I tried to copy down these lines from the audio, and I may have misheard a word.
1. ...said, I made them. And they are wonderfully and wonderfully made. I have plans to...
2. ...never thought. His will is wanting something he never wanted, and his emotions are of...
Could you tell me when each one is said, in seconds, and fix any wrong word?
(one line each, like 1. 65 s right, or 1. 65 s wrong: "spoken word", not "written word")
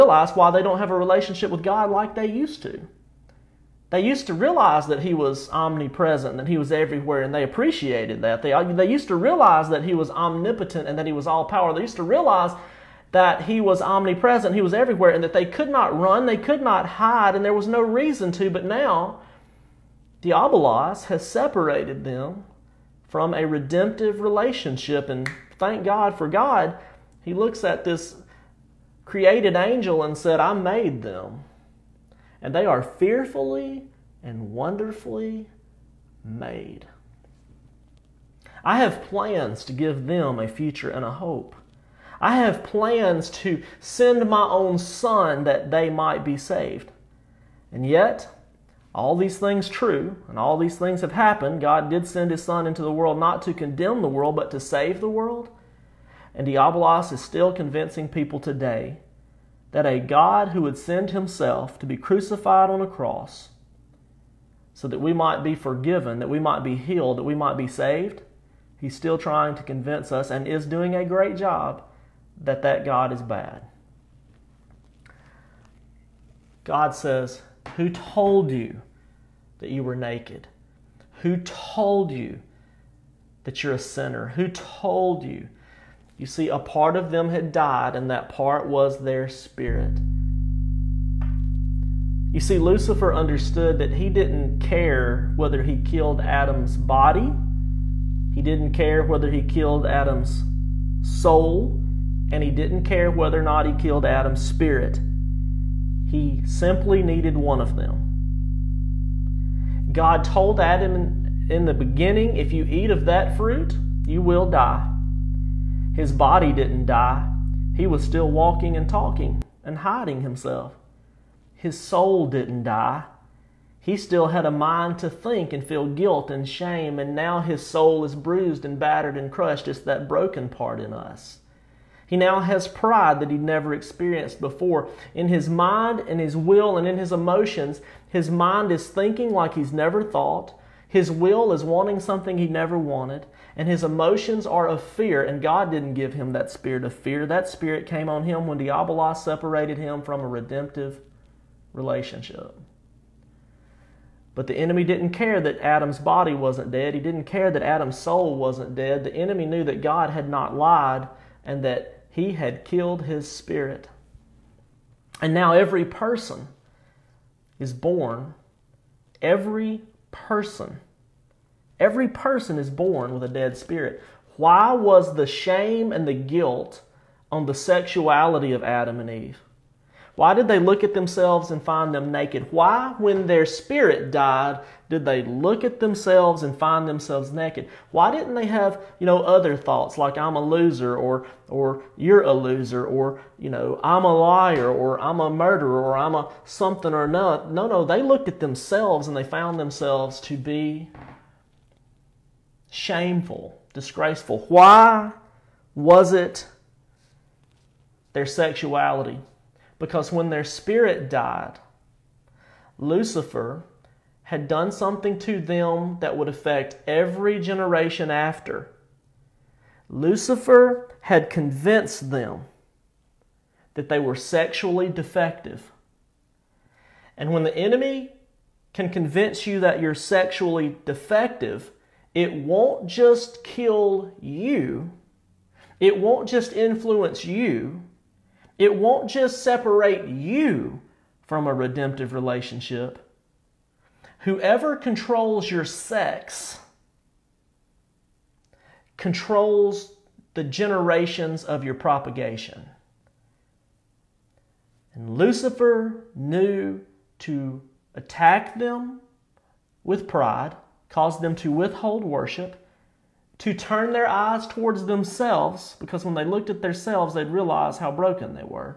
1. 30 s wrong: "fearfully", not "wonderfully"
2. 139 s right.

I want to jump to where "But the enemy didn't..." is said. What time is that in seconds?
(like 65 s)
154 s.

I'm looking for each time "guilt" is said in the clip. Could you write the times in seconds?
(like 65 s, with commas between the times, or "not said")
125 s, 176 s.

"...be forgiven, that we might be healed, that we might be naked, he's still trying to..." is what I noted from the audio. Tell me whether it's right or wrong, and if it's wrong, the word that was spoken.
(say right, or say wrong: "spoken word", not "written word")
wrong: "saved", not "naked".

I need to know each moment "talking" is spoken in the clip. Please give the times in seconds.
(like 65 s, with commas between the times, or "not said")
118 s.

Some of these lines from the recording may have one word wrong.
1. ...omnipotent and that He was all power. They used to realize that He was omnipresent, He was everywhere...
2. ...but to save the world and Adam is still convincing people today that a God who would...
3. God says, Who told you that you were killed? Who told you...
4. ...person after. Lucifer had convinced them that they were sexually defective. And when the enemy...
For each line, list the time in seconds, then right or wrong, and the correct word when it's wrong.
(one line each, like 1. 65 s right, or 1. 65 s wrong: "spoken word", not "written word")
1. 10 s right
2. 54 s wrong: "Diabolos", not "Adam"
3. 76 s wrong: "naked", not "killed"
4. 217 s wrong: "generation", not "person".